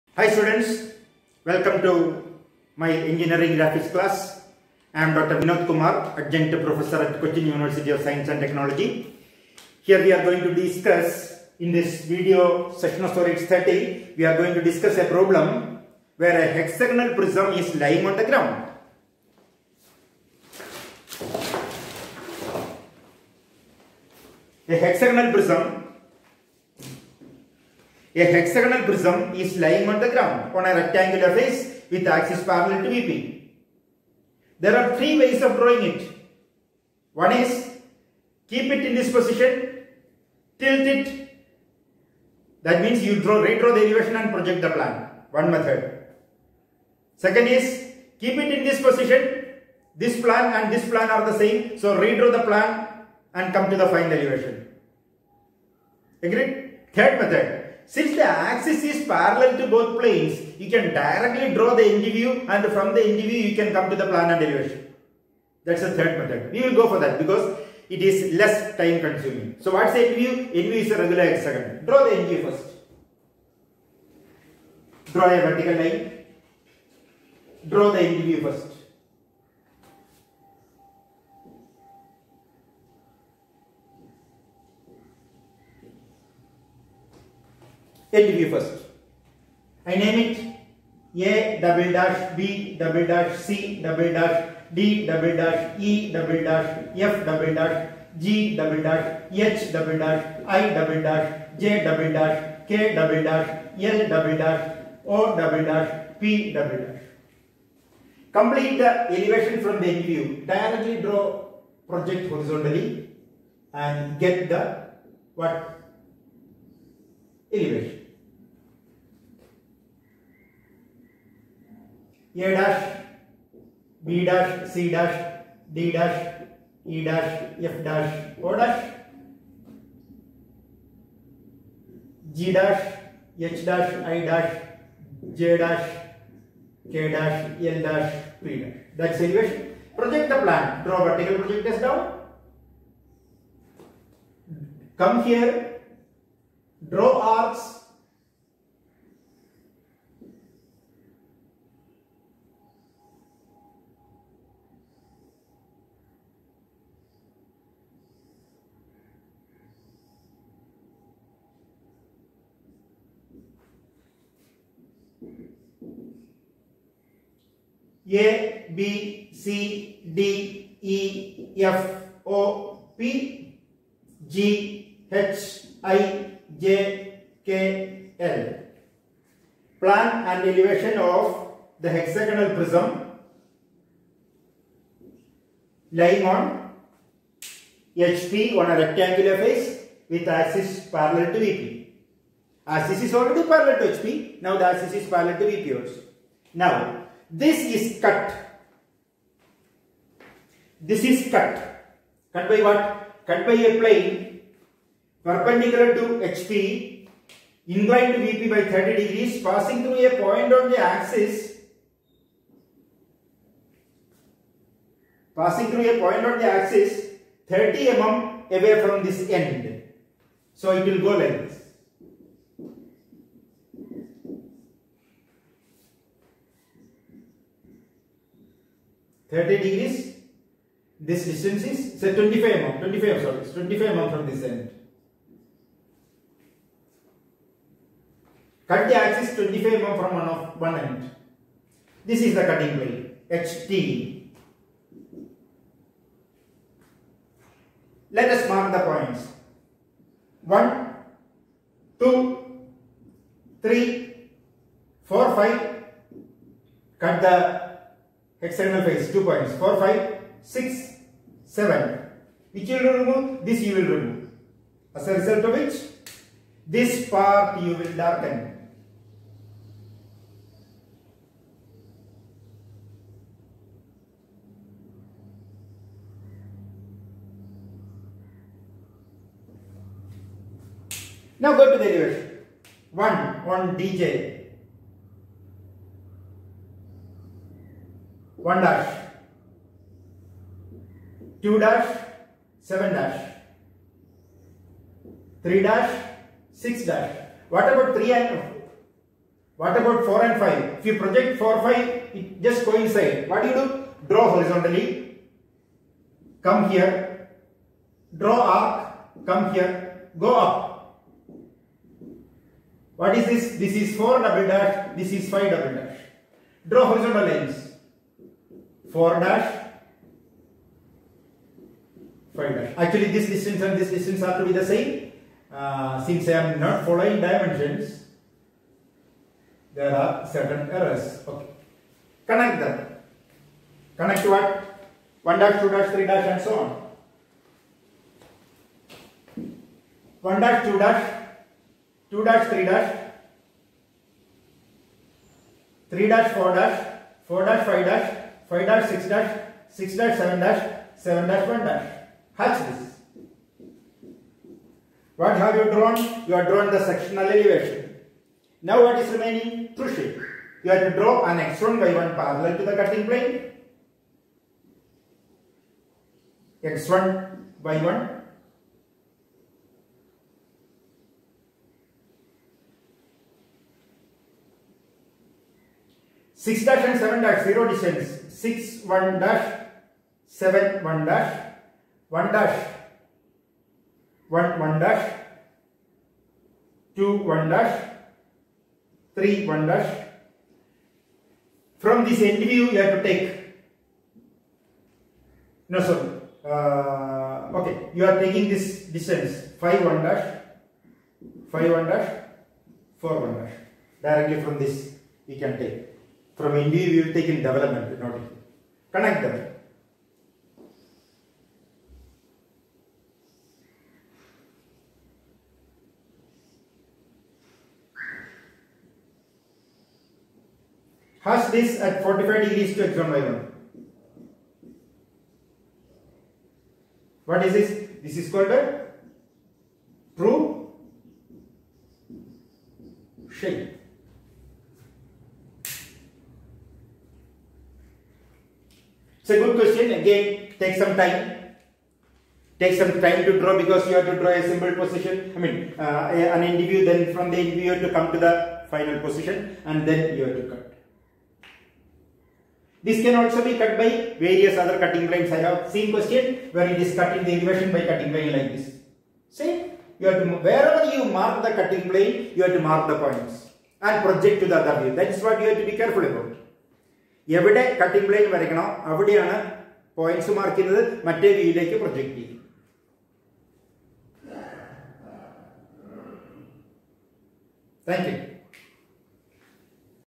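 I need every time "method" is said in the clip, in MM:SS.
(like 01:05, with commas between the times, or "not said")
00:45, 00:57, 01:06.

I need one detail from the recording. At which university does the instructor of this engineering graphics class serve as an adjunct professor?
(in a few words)
Cochin University of Science and Technology.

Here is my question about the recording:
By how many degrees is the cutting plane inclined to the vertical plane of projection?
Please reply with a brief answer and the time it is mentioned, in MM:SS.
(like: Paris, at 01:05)
30 degrees, at 03:27.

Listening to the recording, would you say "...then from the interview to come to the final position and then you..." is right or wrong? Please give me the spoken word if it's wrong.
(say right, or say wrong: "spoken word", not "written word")
right.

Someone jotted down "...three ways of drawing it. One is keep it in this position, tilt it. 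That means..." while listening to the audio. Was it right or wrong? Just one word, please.
right.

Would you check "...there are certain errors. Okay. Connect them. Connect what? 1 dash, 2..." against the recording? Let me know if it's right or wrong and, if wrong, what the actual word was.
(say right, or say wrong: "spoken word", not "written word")
right.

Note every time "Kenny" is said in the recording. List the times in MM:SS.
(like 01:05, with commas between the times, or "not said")
not said.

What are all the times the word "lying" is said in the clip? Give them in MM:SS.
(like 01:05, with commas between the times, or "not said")
00:17, 00:29, 03:05.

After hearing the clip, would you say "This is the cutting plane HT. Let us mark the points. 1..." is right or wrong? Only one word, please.
right.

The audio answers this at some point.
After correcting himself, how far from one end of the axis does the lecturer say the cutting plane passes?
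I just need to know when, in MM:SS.
03:53.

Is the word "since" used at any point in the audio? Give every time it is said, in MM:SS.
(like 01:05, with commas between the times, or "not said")
00:57, 05:26.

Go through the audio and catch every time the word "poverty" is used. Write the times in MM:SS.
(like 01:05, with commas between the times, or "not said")
not said.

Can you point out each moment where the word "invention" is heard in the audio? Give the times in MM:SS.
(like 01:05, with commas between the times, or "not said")
not said.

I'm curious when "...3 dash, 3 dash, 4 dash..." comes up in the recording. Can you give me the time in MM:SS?
05:42.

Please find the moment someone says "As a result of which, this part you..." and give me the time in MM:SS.
04:24.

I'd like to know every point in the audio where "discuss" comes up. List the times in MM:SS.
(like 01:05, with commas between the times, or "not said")
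00:10, 00:14.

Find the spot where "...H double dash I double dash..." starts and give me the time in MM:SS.
01:39.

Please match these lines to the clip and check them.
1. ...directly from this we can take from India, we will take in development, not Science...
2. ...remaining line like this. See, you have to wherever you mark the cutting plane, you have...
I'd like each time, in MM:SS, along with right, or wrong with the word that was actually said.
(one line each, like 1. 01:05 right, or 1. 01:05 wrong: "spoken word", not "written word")
1. 06:44 wrong: "Connect", not "Science"
2. 07:37 wrong: "cutting", not "remaining".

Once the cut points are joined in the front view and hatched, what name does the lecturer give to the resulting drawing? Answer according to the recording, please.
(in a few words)
Sectional elevation.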